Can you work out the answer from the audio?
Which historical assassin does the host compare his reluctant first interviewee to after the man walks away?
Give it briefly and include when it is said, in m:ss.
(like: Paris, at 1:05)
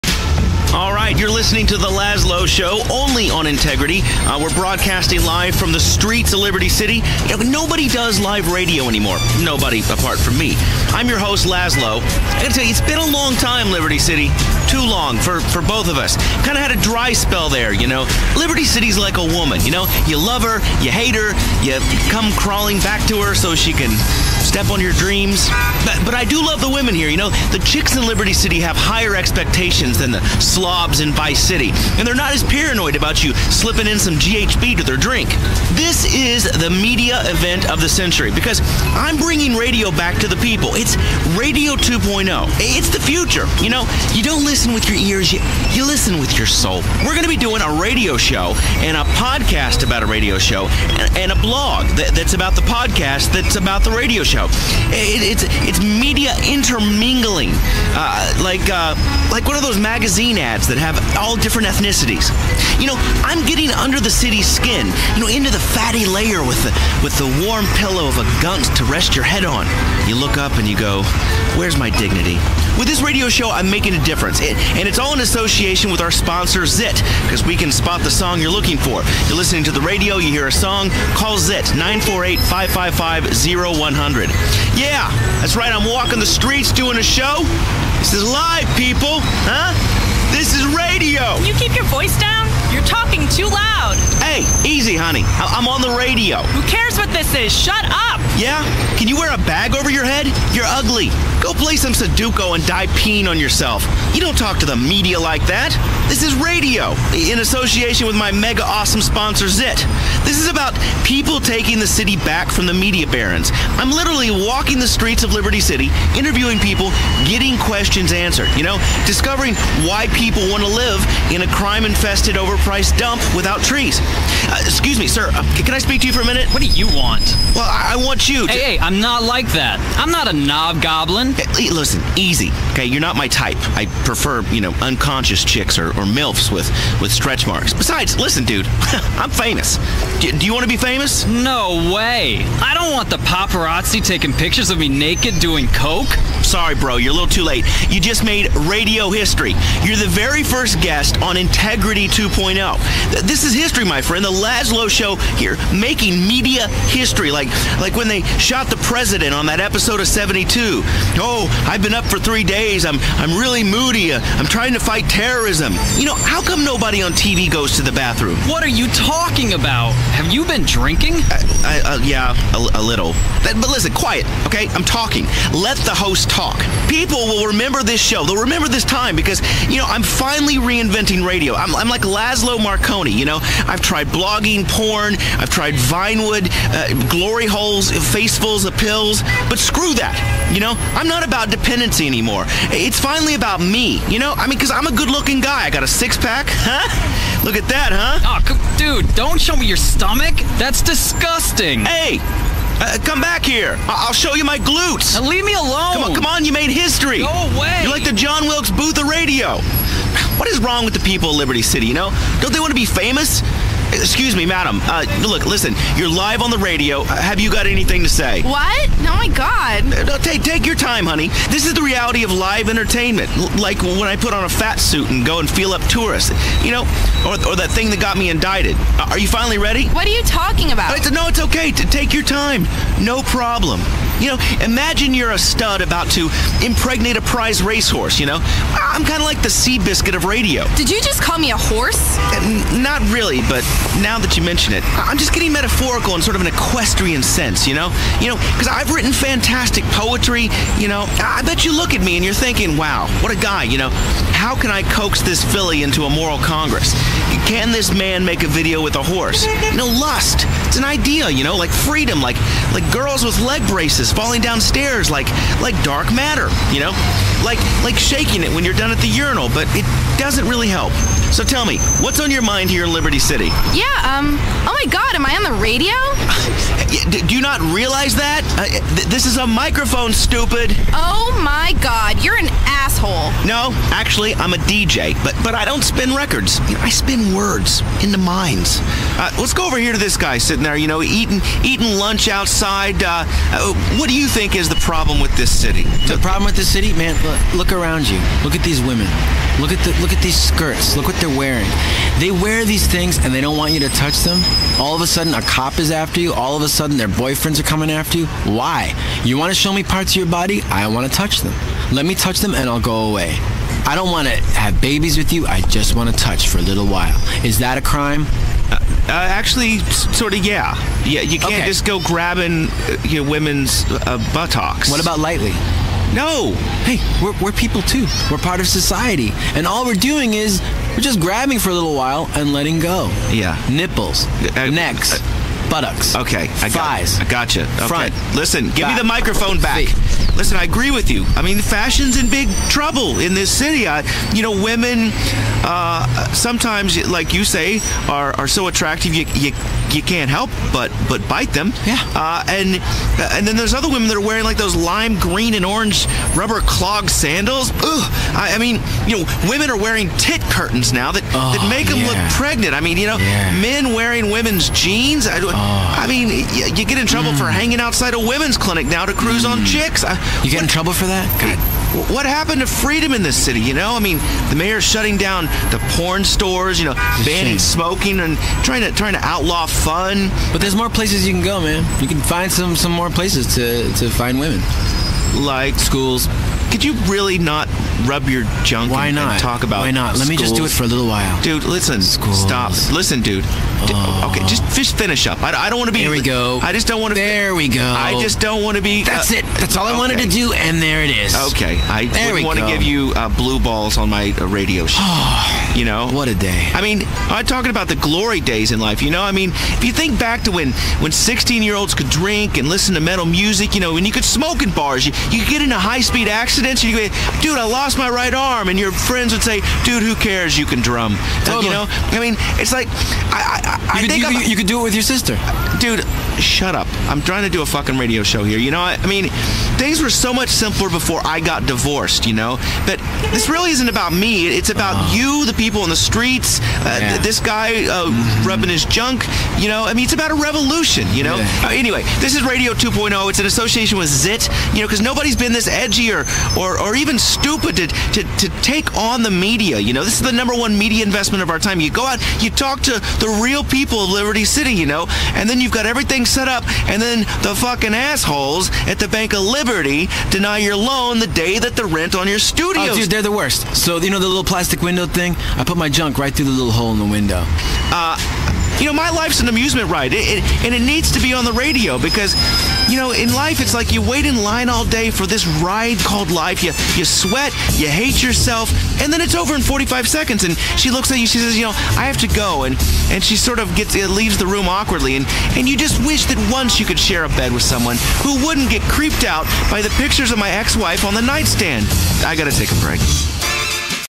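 John Wilkes Booth, at 3:28.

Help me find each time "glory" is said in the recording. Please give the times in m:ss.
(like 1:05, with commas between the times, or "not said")
3:07, 6:47.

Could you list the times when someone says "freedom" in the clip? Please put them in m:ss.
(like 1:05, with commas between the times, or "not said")
4:21, 6:12.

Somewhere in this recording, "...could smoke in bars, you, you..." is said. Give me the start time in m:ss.
6:54.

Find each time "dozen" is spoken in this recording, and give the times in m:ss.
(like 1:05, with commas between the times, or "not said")
not said.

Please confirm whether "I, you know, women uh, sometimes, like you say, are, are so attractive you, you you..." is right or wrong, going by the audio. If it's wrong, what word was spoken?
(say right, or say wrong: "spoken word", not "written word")
right.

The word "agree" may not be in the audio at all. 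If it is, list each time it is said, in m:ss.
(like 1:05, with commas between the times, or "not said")
5:40.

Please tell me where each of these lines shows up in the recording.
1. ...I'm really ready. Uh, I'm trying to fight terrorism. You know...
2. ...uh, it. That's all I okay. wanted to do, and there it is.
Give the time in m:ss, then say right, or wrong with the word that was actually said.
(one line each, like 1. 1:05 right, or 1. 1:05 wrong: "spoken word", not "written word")
1. 2:43 wrong: "moody", not "ready"
2. 6:39 right.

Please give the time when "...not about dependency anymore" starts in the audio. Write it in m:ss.
3:11.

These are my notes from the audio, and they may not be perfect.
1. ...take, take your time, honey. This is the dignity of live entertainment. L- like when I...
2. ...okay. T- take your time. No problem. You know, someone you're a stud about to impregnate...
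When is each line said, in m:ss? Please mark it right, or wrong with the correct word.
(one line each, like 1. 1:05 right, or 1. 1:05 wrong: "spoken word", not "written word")
1. 3:40 wrong: "reality", not "dignity"
2. 3:51 wrong: "imagine", not "someone".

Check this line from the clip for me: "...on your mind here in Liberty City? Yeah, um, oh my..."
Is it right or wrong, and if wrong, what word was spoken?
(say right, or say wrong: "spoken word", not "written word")
right.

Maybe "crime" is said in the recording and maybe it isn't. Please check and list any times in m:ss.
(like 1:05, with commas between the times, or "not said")
2:01, 5:17.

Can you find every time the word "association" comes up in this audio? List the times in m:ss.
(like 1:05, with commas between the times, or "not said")
1:15, 1:47, 7:23.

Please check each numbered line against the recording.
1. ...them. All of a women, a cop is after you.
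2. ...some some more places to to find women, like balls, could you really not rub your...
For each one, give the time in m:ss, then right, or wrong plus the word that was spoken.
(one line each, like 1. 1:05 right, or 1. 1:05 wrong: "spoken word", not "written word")
1. 5:04 wrong: "sudden", not "women"
2. 6:22 wrong: "schools", not "balls".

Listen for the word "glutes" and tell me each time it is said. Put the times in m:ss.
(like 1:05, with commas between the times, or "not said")
3:24.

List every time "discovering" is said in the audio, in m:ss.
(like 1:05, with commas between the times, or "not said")
1:59.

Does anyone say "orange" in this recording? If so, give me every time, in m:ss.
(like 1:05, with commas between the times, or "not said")
5:55.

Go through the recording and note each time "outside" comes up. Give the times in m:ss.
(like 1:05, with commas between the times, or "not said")
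4:52, 6:07.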